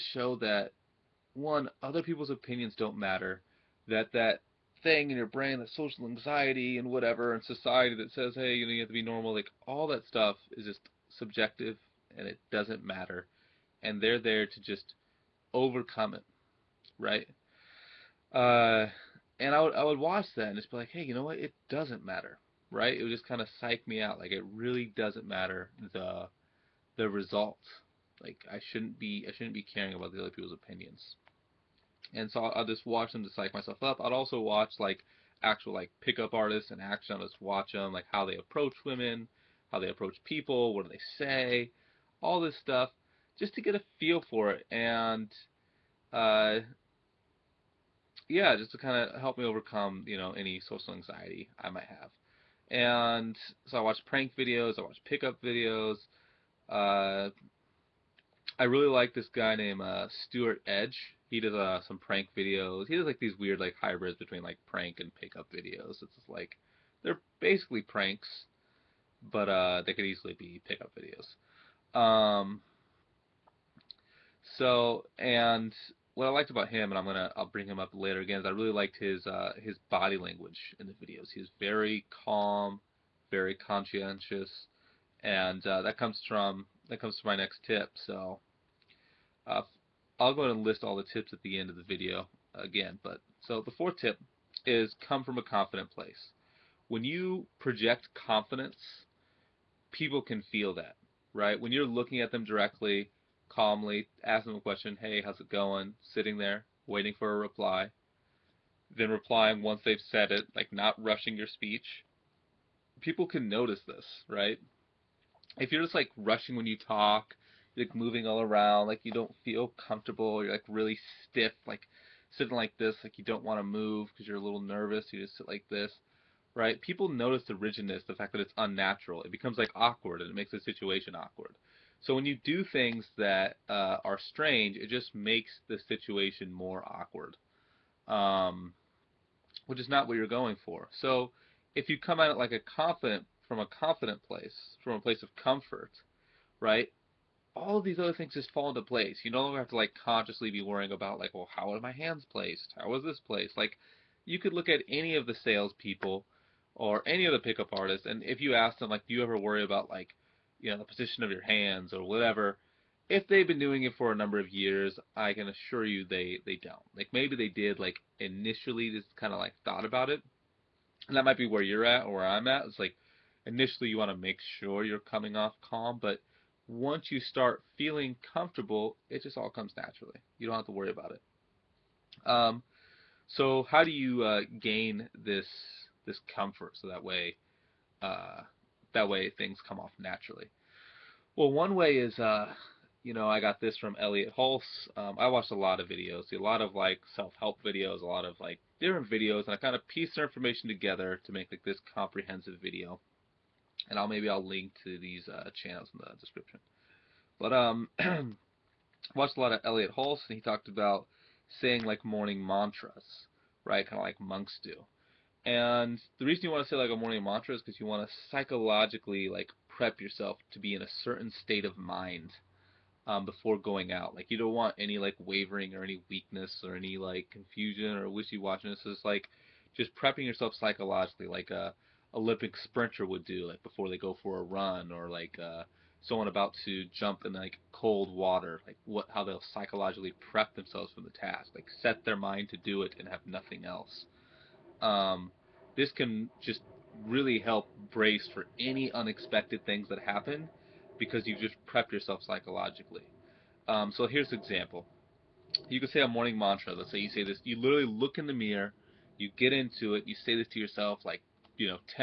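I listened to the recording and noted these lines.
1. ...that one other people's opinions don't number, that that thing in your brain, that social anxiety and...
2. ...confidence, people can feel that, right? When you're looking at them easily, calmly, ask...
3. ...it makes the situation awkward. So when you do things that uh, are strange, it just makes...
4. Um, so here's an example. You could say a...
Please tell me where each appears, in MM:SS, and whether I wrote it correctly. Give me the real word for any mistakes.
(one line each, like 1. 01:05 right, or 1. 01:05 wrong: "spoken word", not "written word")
1. 00:00 wrong: "matter", not "number"
2. 01:38 wrong: "directly", not "easily"
3. 02:10 right
4. 04:13 right.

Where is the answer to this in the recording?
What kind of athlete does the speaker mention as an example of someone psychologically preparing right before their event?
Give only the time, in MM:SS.
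03:52.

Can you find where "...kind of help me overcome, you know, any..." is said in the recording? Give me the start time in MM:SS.
00:48.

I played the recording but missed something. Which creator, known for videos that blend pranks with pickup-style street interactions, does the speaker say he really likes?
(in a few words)
Stuart Edge.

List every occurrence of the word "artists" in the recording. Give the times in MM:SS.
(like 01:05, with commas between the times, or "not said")
00:36, 02:37.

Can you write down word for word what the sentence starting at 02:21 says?
So if you come at it like a confident, from a confident place, from a place of comfort, right?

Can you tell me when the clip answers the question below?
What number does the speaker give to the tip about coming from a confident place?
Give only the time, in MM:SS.
01:33.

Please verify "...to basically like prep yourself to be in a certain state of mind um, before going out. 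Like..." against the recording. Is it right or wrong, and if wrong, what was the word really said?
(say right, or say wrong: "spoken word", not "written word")
wrong: "psychologically", not "basically".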